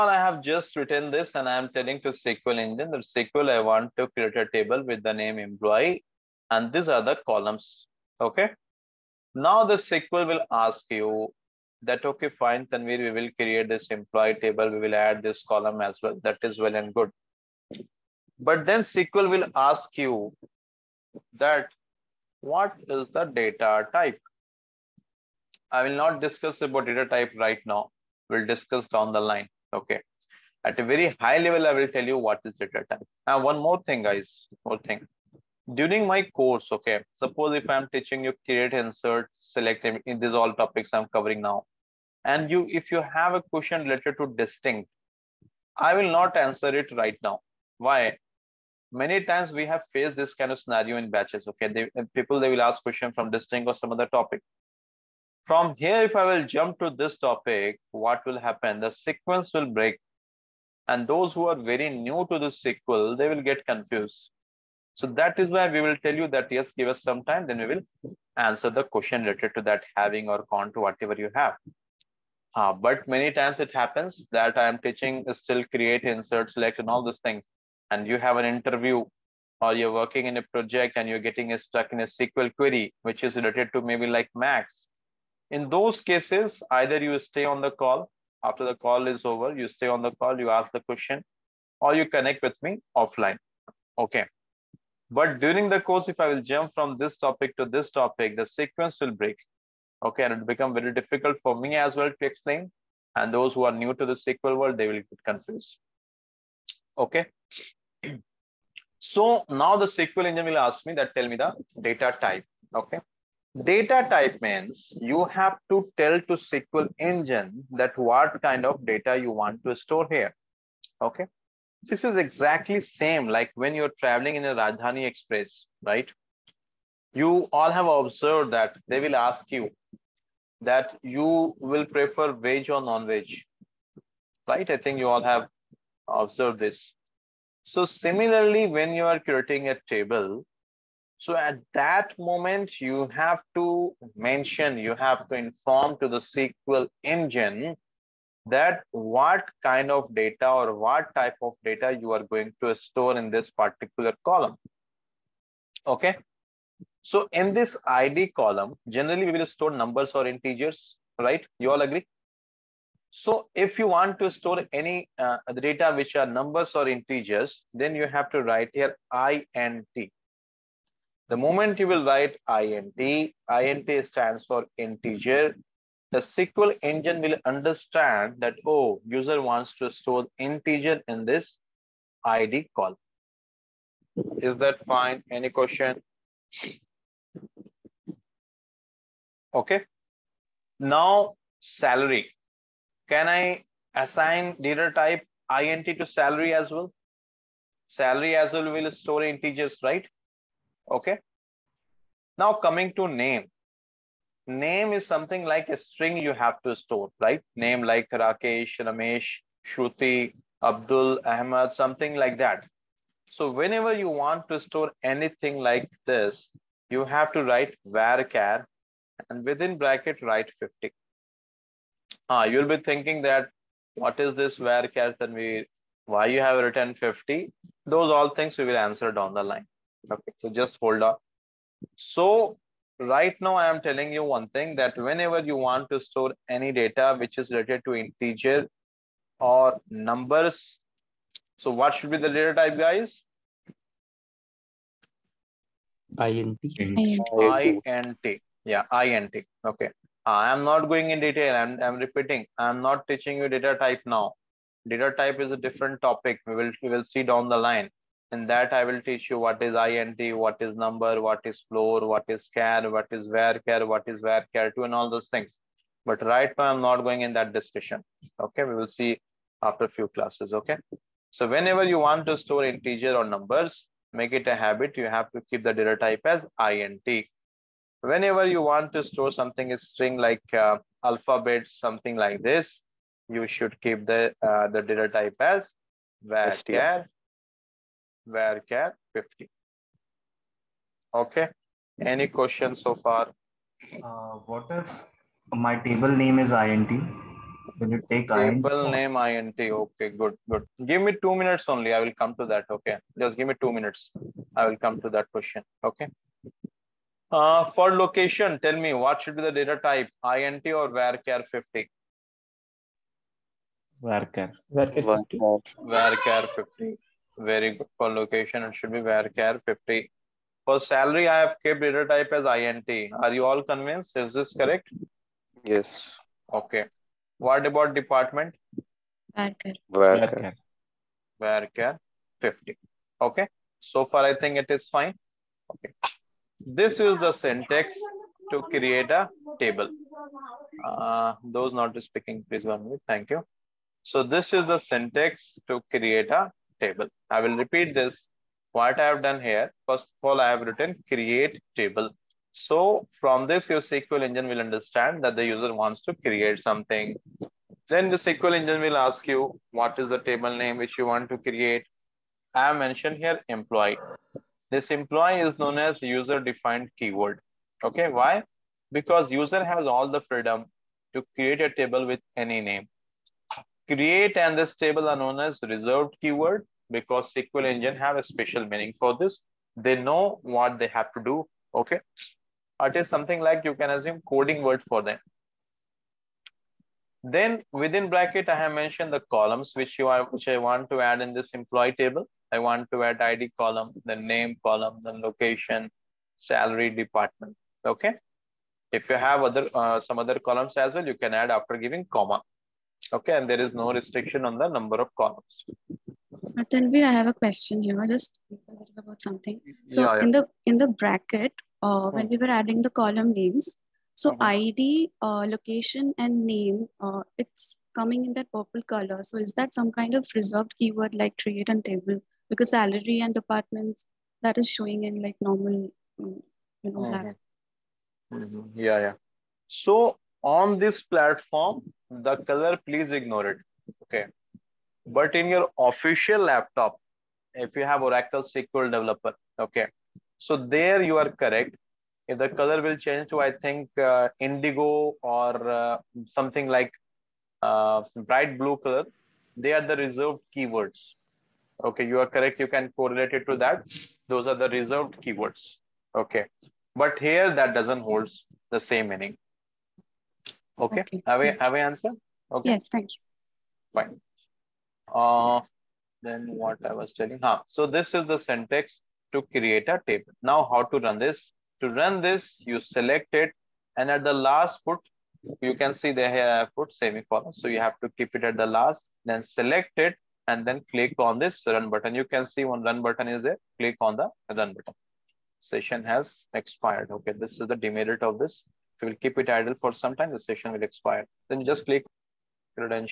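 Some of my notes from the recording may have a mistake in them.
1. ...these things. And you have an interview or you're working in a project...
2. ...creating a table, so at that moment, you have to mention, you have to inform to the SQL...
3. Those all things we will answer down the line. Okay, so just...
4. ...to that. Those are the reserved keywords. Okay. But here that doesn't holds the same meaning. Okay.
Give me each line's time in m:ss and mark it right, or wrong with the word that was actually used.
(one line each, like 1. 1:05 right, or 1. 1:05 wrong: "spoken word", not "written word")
1. 1:17 right
2. 2:19 right
3. 3:47 right
4. 7:33 right.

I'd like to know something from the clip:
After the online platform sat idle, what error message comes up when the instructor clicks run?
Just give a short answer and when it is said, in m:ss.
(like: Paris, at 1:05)
Session has expired, at 8:05.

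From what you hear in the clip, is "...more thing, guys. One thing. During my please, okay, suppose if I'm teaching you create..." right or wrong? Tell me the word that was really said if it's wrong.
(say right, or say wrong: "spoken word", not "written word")
wrong: "course", not "please".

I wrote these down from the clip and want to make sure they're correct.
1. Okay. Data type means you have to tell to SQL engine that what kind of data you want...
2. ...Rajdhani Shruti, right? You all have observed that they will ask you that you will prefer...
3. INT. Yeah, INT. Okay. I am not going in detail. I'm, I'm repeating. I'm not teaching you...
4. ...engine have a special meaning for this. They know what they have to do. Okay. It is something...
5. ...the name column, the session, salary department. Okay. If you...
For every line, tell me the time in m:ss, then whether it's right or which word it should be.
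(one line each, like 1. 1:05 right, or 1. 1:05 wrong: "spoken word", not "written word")
1. 1:52 right
2. 2:04 wrong: "Express", not "Shruti"
3. 4:06 right
4. 6:17 right
5. 6:34 wrong: "location", not "session".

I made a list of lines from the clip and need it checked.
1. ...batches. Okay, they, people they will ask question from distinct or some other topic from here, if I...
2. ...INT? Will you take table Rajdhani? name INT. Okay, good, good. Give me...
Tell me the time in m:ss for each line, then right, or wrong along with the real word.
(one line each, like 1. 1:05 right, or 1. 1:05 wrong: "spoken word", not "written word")
1. 0:51 right
2. 4:56 wrong: "INT", not "Rajdhani".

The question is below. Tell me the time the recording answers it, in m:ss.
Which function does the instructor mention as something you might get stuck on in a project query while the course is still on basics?
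1:24.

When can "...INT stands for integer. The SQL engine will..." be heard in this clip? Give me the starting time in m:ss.
2:53.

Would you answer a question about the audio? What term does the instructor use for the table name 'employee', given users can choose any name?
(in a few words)
user-defined keyword.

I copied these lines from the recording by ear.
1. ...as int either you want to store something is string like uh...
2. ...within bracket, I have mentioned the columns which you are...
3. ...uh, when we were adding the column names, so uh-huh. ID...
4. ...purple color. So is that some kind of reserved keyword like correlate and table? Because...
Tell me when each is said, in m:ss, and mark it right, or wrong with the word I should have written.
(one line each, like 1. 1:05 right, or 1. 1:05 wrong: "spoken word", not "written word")
1. 4:36 wrong: "whenever", not "either"
2. 6:27 right
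3. 6:51 right
4. 6:58 wrong: "create", not "correlate".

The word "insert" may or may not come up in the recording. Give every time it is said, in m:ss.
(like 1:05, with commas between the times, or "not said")
0:38, 1:16.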